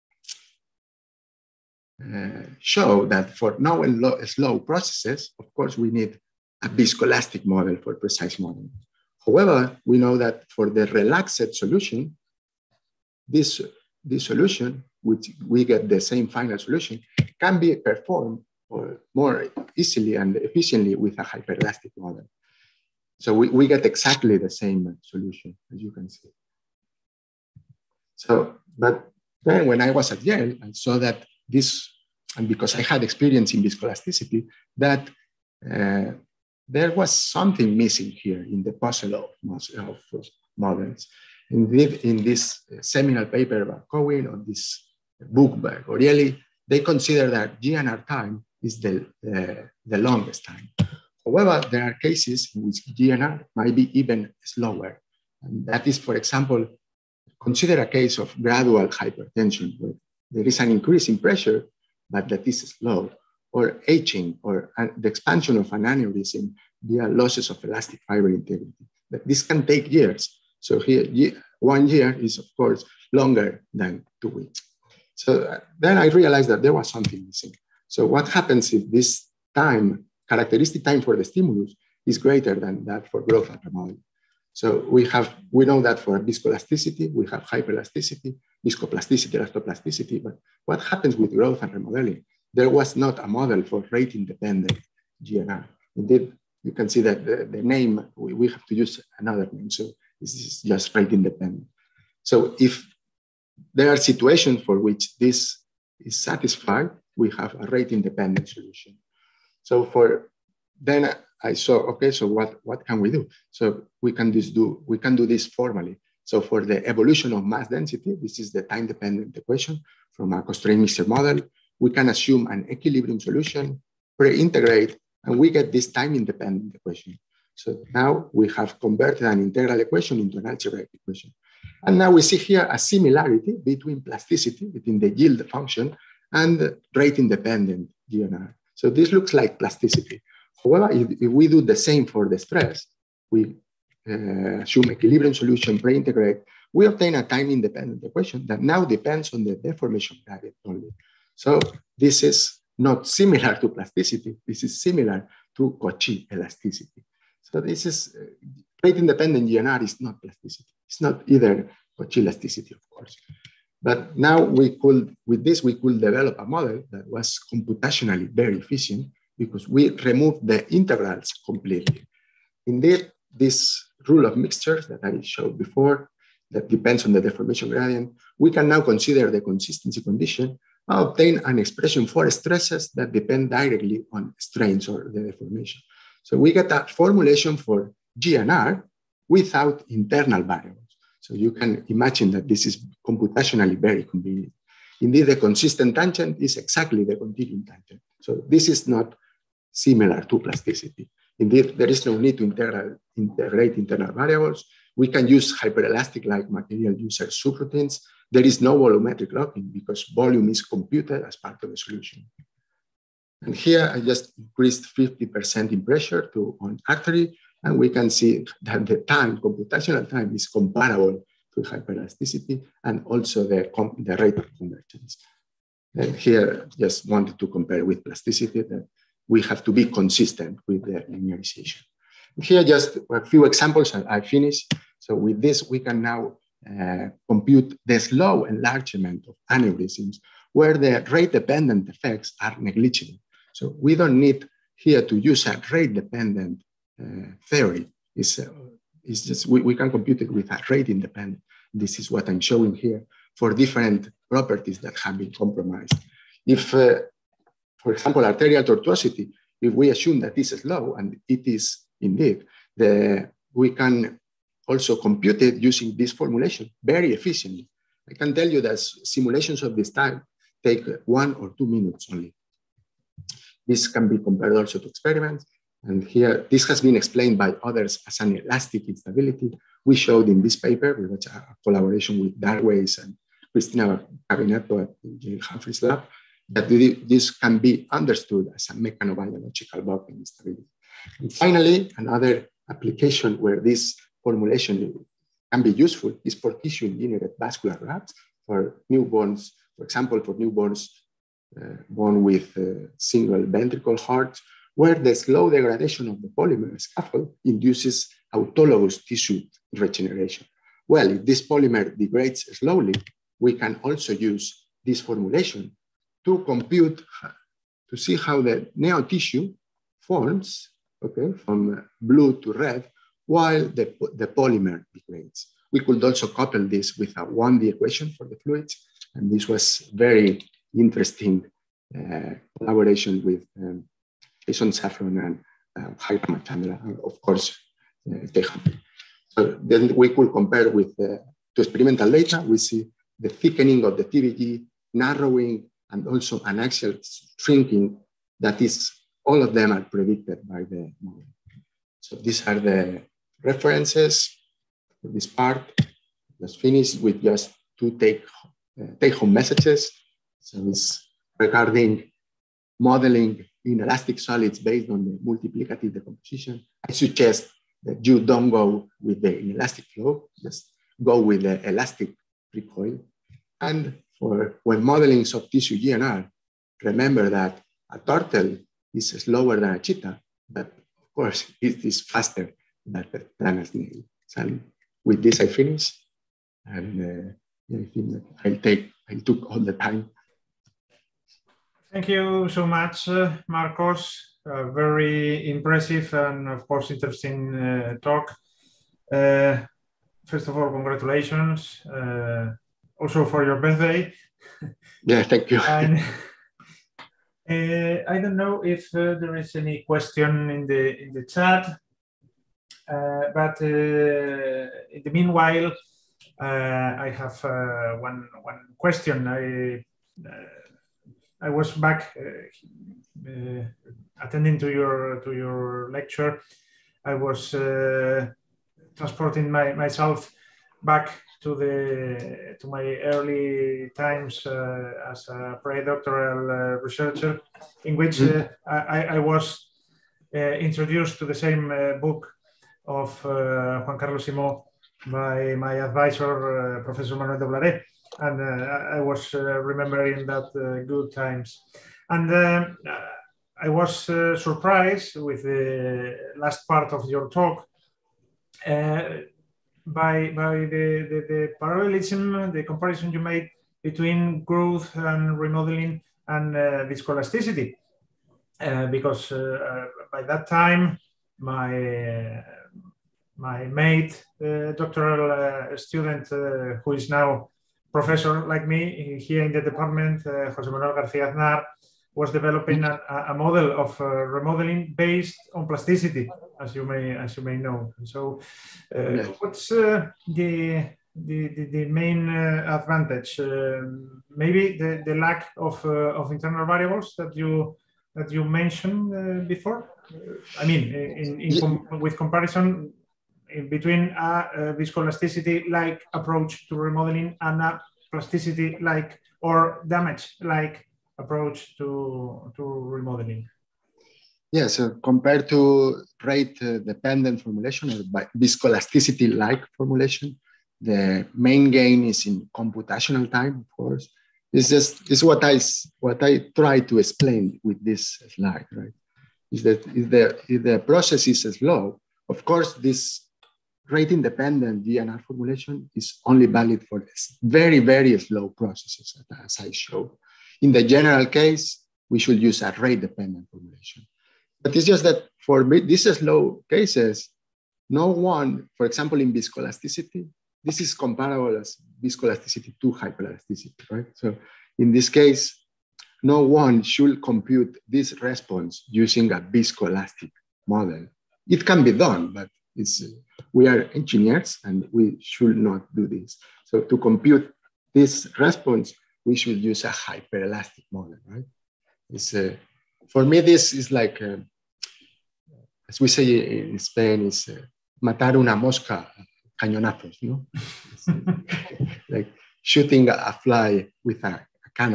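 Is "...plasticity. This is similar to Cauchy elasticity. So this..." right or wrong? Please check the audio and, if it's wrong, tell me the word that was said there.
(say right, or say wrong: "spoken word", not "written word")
right.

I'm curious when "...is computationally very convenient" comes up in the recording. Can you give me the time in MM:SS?
03:12.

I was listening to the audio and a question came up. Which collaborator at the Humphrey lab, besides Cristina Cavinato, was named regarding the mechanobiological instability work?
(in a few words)
Dar Weiss.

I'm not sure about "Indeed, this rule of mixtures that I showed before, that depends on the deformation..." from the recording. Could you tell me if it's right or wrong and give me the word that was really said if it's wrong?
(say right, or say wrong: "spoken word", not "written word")
right.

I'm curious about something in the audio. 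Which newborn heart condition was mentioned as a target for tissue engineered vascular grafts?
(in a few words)
single ventricle hearts.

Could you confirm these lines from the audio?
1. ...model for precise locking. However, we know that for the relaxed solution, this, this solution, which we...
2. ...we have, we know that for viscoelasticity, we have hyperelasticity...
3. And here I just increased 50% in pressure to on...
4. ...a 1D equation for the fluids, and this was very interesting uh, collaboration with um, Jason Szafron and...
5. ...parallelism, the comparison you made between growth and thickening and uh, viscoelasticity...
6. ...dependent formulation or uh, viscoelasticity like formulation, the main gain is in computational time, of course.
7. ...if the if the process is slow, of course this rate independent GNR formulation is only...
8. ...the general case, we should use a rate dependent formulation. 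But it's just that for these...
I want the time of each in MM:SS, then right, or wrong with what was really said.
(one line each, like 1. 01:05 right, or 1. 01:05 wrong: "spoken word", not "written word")
1. 00:07 wrong: "modeling", not "locking"
2. 01:24 right
3. 03:33 right
4. 05:27 right
5. 07:41 wrong: "remodeling", not "thickening"
6. 08:36 right
7. 08:49 right
8. 09:00 right.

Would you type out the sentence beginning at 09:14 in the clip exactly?
So in this case, no one should compute this response using a viscoelastic model.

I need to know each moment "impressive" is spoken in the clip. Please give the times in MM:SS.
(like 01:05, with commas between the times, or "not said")
06:35.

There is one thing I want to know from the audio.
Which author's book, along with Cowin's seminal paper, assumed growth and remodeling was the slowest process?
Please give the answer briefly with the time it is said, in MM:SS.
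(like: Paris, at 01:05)
Goriely, at 00:45.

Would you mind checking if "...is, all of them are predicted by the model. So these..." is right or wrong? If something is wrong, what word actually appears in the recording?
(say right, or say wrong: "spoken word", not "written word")
right.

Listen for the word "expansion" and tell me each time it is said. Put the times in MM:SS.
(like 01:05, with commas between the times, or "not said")
01:05.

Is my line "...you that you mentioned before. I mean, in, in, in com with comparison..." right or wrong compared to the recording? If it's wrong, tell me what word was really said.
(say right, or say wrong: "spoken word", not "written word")
right.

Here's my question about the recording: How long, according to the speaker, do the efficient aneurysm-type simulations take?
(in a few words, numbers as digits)
one or two minutes.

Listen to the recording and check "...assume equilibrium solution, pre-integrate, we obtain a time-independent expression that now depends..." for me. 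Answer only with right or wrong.
wrong.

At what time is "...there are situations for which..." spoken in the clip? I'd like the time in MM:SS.
01:43.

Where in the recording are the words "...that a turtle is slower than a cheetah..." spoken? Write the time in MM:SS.
06:17.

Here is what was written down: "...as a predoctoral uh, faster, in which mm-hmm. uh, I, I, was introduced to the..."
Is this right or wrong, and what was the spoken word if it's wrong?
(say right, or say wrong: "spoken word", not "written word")
wrong: "researcher", not "faster".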